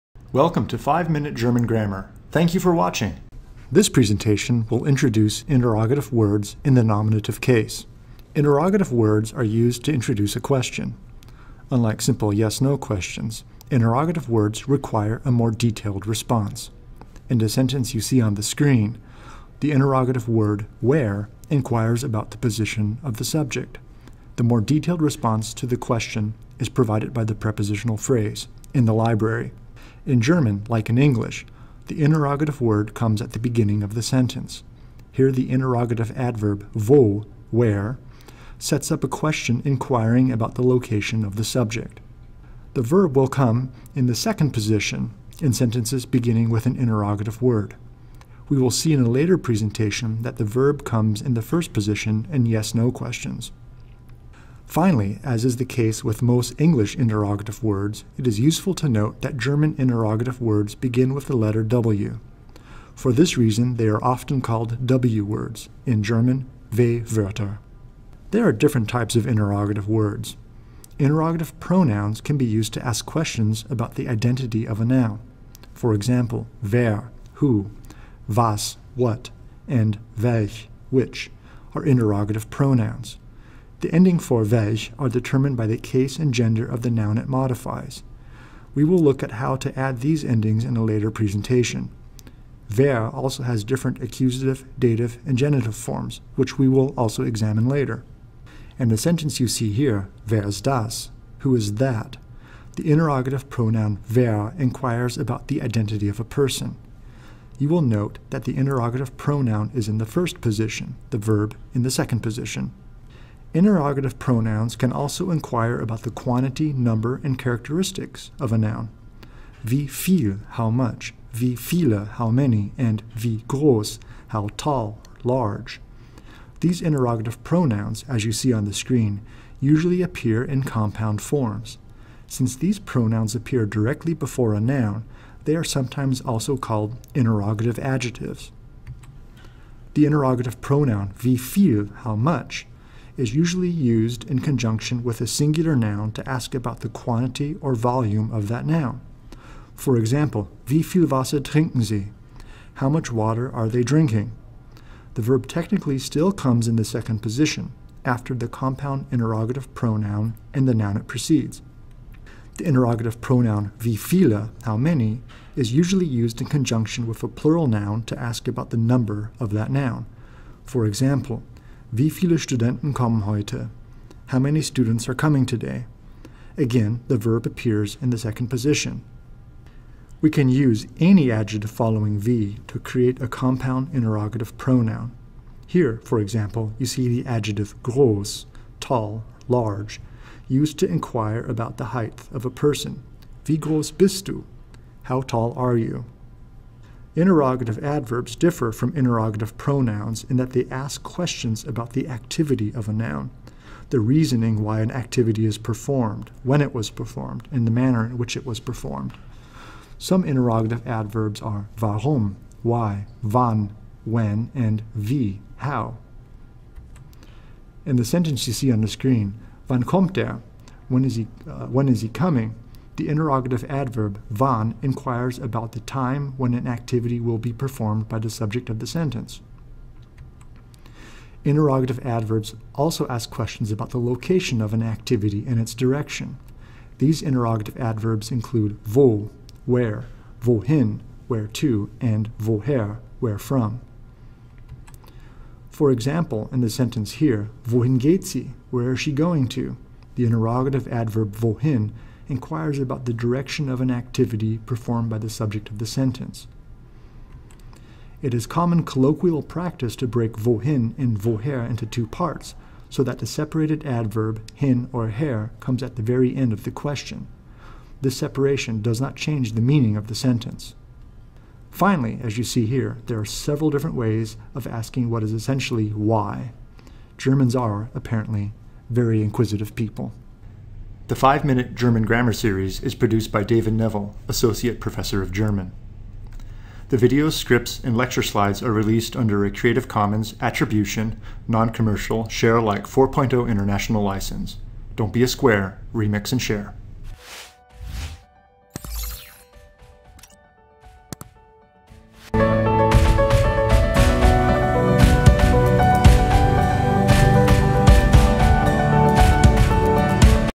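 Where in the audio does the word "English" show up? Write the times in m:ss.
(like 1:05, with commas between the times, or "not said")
0:30, 0:56.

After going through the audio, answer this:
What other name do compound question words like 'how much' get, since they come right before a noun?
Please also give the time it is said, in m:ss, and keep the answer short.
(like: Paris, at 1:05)
interrogative adjectives, at 2:17.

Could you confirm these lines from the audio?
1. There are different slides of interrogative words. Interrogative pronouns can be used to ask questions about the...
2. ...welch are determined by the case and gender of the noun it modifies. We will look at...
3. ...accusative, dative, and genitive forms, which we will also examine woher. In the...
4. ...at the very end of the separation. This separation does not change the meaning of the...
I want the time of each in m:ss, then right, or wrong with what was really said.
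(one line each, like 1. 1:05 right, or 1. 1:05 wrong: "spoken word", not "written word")
1. 1:08 wrong: "types", not "slides"
2. 1:24 right
3. 1:33 wrong: "later", not "woher"
4. 4:25 wrong: "question", not "separation".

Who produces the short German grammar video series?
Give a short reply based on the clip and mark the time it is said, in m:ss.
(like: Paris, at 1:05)
David Neville, at 4:43.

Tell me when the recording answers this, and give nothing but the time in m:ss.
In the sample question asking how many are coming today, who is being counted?
2:52.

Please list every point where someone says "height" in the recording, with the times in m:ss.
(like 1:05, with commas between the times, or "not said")
3:11.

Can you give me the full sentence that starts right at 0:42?
The verb will come in the second position in sentences beginning with an interrogative word.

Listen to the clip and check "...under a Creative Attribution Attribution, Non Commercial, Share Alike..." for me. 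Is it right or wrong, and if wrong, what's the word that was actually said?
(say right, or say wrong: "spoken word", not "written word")
wrong: "Commons", not "Attribution".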